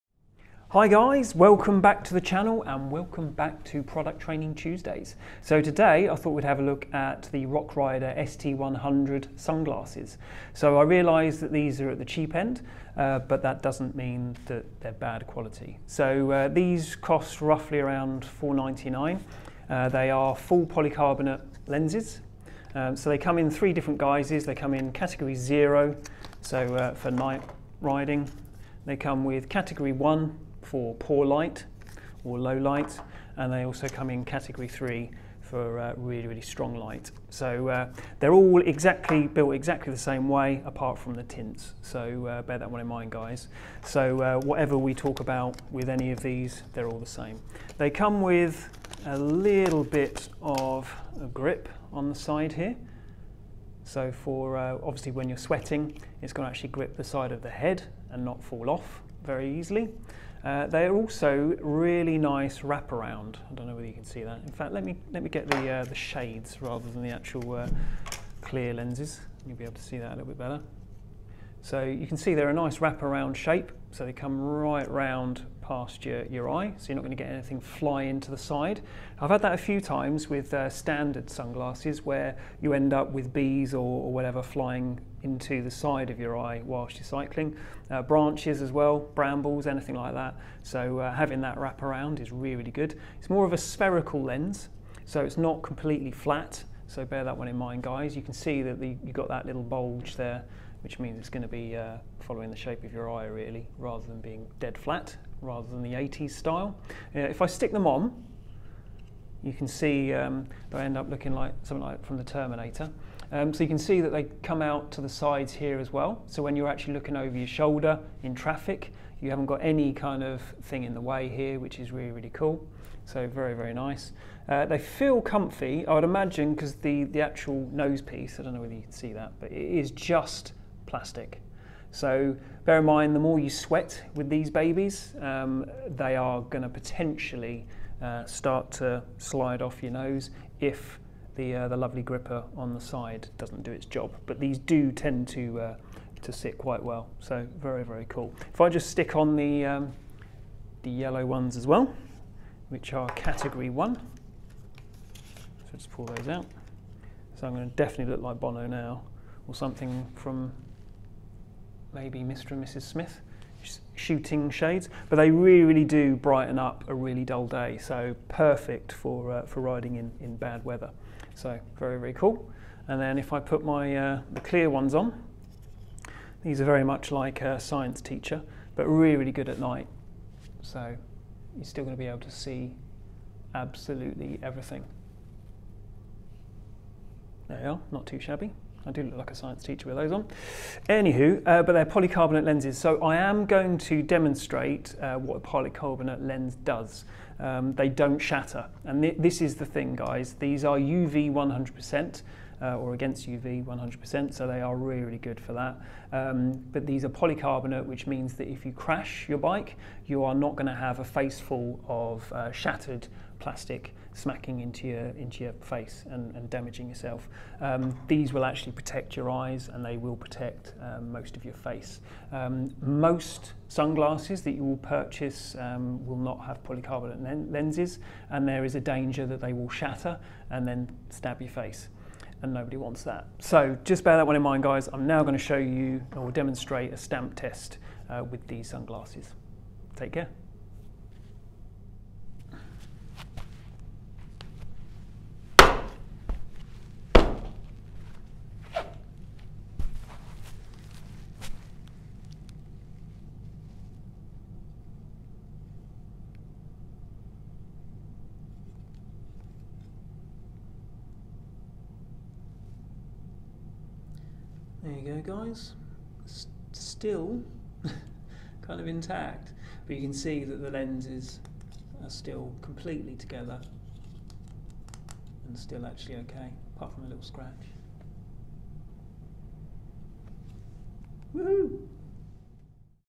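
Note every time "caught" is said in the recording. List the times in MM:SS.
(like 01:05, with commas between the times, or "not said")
not said.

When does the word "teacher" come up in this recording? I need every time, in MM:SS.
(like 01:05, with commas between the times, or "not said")
02:58, 03:09.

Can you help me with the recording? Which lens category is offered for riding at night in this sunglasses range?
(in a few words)
Category zero.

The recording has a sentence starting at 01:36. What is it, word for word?
So bear that one in mind, guys.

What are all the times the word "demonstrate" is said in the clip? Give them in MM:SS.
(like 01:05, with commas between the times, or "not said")
03:14, 03:56.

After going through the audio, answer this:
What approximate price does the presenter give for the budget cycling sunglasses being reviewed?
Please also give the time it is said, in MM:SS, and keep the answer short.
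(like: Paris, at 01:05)
$4.99, at 00:18.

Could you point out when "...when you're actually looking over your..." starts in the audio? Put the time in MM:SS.
01:56.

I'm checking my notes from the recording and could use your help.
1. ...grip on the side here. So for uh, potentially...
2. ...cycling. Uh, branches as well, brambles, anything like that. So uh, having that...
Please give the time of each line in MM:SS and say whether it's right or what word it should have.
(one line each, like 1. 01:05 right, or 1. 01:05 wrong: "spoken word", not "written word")
1. 00:51 wrong: "obviously", not "potentially"
2. 01:27 right.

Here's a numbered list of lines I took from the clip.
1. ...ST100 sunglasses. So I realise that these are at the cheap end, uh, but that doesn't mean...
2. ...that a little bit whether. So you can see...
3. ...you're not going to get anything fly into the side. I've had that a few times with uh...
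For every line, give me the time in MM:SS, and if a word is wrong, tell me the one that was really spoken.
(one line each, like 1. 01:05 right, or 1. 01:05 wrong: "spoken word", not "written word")
1. 00:08 right
2. 01:09 wrong: "better", not "whether"
3. 01:16 right.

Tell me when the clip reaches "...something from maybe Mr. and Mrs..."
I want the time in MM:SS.
02:39.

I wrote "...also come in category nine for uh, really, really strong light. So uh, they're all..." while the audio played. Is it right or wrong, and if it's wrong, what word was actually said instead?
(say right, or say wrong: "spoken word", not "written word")
wrong: "three", not "nine".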